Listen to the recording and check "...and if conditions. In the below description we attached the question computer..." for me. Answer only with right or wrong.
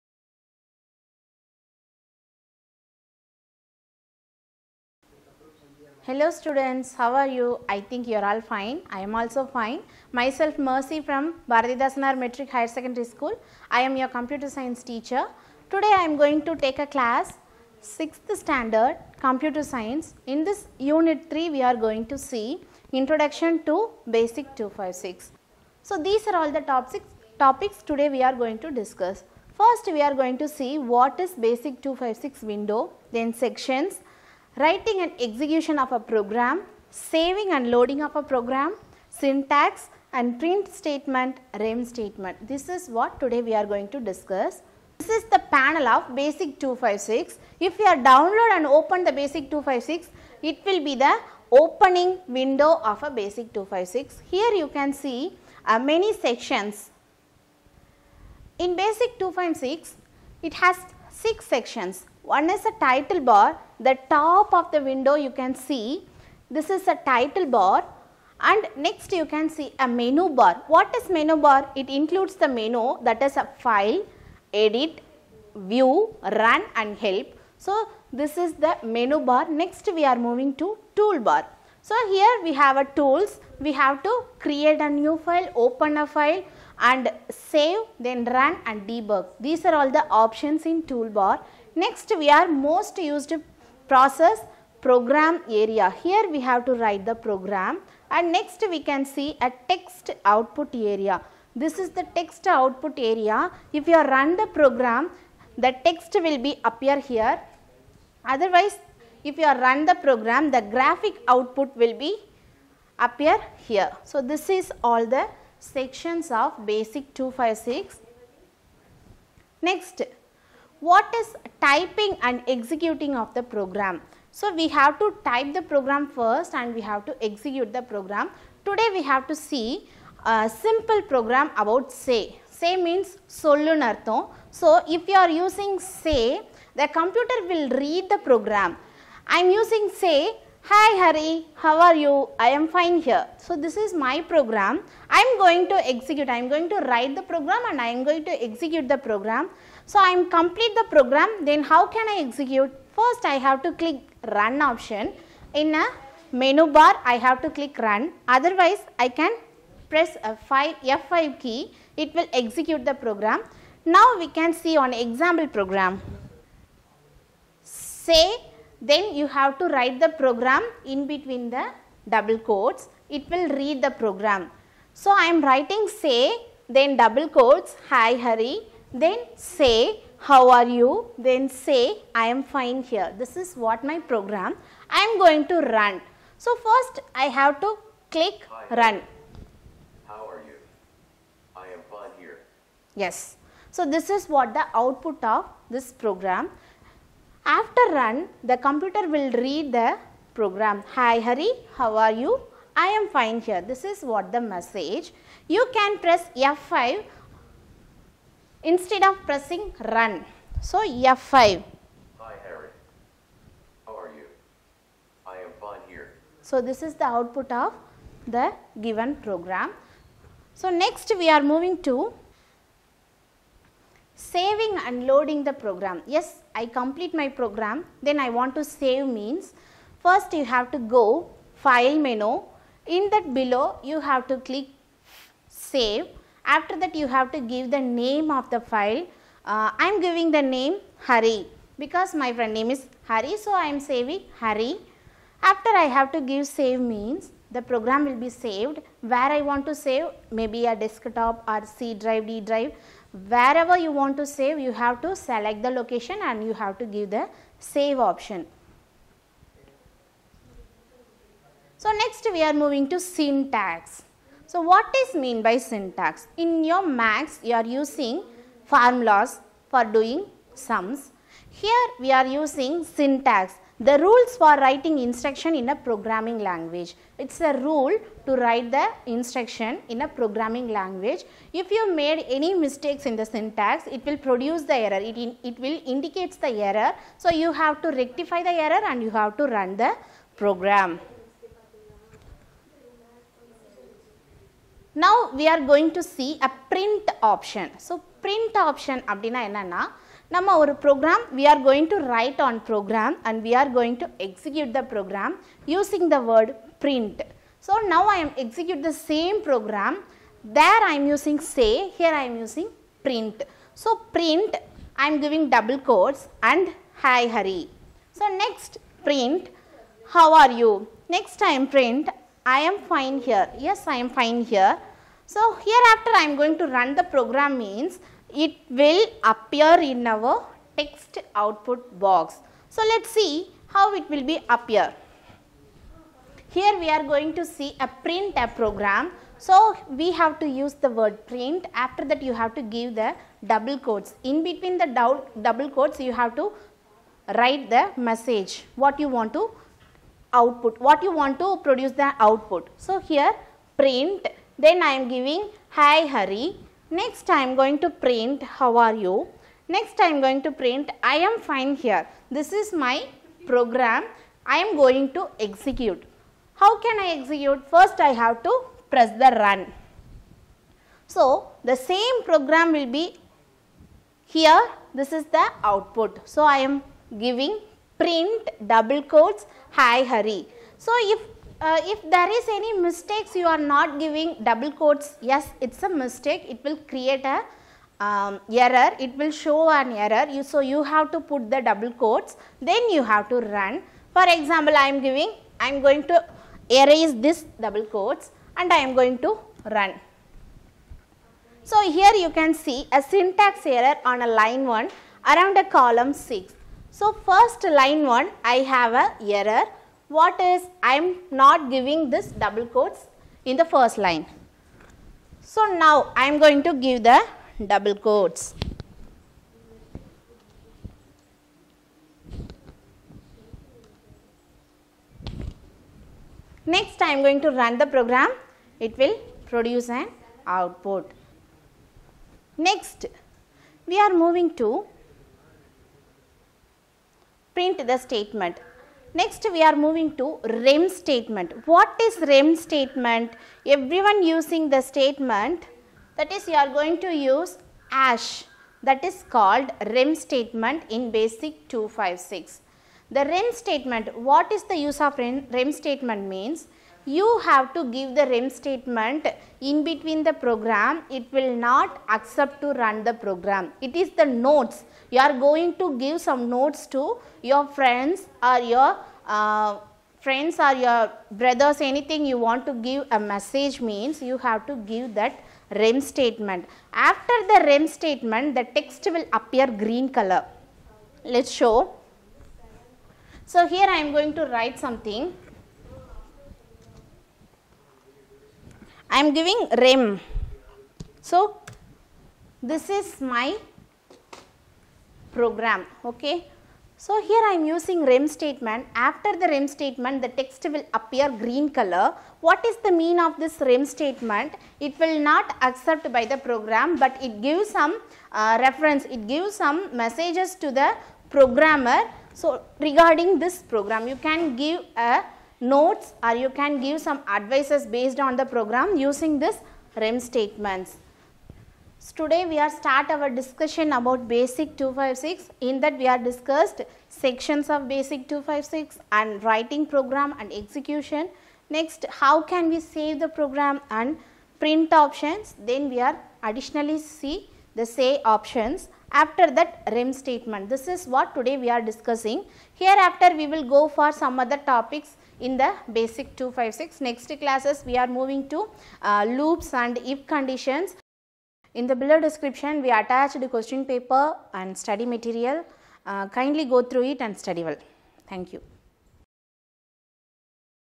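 wrong.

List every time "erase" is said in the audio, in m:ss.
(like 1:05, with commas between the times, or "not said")
6:36.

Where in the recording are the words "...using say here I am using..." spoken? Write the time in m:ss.
5:11.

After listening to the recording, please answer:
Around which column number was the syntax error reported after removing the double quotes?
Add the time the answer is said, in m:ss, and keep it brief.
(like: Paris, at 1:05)
6, at 6:45.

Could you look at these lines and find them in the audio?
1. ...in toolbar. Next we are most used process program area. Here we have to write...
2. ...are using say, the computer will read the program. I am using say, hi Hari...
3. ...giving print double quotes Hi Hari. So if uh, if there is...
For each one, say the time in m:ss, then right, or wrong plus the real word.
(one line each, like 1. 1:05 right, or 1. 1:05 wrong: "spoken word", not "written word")
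1. 1:30 right
2. 2:15 right
3. 6:17 right.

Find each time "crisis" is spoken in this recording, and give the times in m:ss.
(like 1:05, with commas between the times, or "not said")
not said.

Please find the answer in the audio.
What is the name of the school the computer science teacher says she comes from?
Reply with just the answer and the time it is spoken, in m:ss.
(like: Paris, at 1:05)
Bharathidhasanar Matric Higher Secondary School, at 0:11.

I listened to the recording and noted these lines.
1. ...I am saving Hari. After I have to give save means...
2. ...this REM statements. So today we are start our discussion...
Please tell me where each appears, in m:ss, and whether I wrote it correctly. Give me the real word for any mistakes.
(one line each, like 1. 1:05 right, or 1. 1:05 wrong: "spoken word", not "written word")
1. 4:03 right
2. 8:39 right.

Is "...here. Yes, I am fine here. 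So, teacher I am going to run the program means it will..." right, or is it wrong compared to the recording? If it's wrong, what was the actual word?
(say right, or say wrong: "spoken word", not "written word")
wrong: "hereafter", not "teacher".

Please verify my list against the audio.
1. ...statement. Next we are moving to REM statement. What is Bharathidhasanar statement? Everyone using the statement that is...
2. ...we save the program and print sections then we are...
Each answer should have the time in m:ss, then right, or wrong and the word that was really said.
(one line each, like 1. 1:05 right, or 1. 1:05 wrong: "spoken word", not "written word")
1. 7:17 wrong: "REM", not "Bharathidhasanar"
2. 8:52 wrong: "options", not "sections".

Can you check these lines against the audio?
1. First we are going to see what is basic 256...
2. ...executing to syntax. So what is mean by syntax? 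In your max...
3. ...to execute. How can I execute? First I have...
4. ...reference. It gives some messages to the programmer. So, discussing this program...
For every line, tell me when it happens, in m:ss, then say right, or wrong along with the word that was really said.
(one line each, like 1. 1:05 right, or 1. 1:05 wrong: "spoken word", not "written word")
1. 0:29 right
2. 4:22 wrong: "moving", not "executing"
3. 6:05 right
4. 8:28 wrong: "regarding", not "discussing".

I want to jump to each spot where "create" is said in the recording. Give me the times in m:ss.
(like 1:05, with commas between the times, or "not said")
1:24, 6:26.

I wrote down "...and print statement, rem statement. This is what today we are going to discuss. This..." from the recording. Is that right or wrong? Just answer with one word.
right.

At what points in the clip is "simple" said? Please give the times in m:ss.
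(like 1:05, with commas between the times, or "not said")
2:10.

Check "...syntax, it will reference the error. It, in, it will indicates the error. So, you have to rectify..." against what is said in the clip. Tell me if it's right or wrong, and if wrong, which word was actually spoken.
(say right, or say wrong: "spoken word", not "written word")
wrong: "produce", not "reference".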